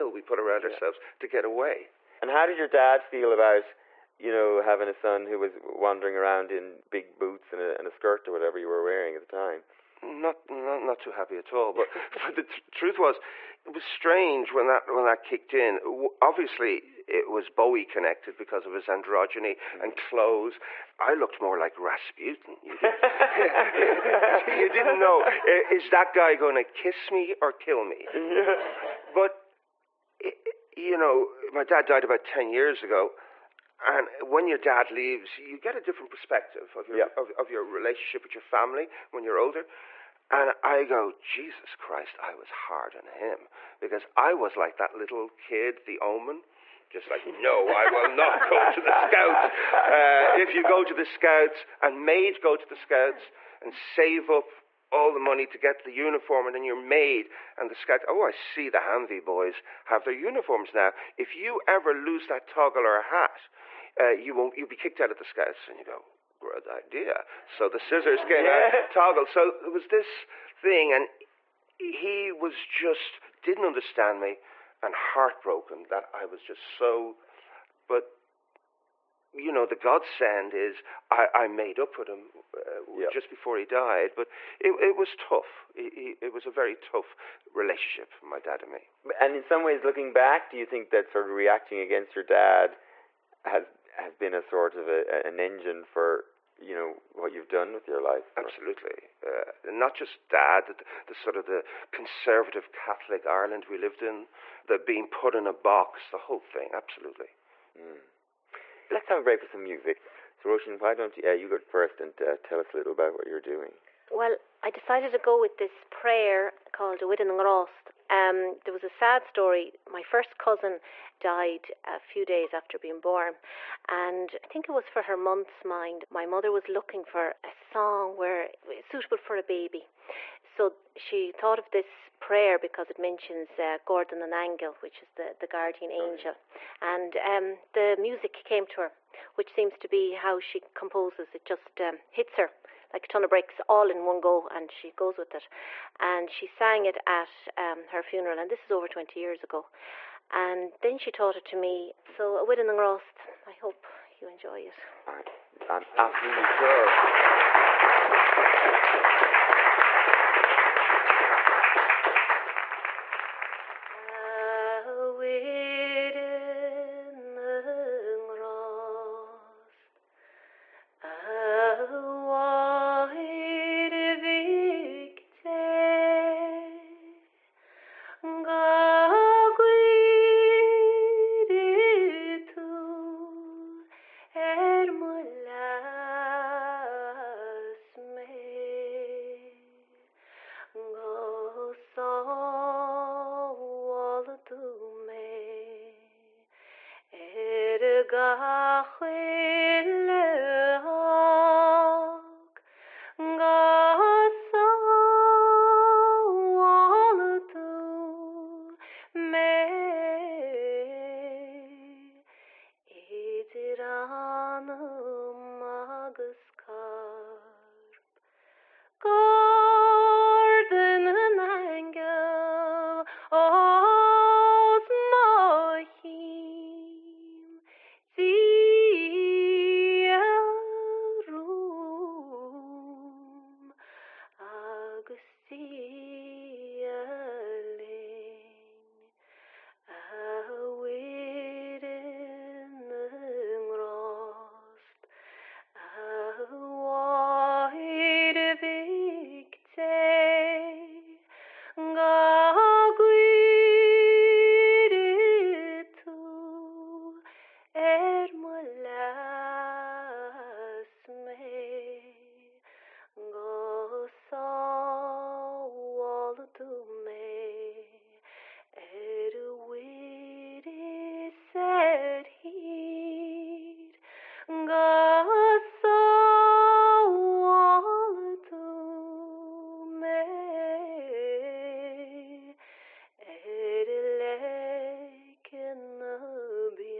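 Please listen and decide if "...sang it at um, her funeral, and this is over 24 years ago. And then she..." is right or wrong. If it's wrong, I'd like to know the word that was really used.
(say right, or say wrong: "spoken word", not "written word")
wrong: "20", not "24".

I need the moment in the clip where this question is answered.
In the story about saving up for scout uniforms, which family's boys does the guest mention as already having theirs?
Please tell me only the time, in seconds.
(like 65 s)
58 s.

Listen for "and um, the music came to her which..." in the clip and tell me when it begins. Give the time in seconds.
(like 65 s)
136 s.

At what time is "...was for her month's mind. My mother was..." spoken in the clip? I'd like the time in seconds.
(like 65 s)
124 s.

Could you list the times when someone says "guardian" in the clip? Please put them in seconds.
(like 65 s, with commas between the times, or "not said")
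135 s.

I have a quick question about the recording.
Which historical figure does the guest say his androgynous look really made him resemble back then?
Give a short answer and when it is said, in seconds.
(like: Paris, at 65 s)
Rasputin, at 21 s.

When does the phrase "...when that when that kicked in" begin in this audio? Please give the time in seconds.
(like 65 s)
14 s.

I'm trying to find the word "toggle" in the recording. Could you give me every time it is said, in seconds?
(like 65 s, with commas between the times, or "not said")
62 s, 68 s.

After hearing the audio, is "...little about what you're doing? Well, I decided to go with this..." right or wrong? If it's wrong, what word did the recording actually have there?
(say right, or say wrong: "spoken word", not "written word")
right.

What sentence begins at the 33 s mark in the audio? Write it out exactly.
And when your dad leaves, you get a different perspective of your, yeah.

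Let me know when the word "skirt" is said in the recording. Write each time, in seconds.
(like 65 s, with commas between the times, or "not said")
7 s.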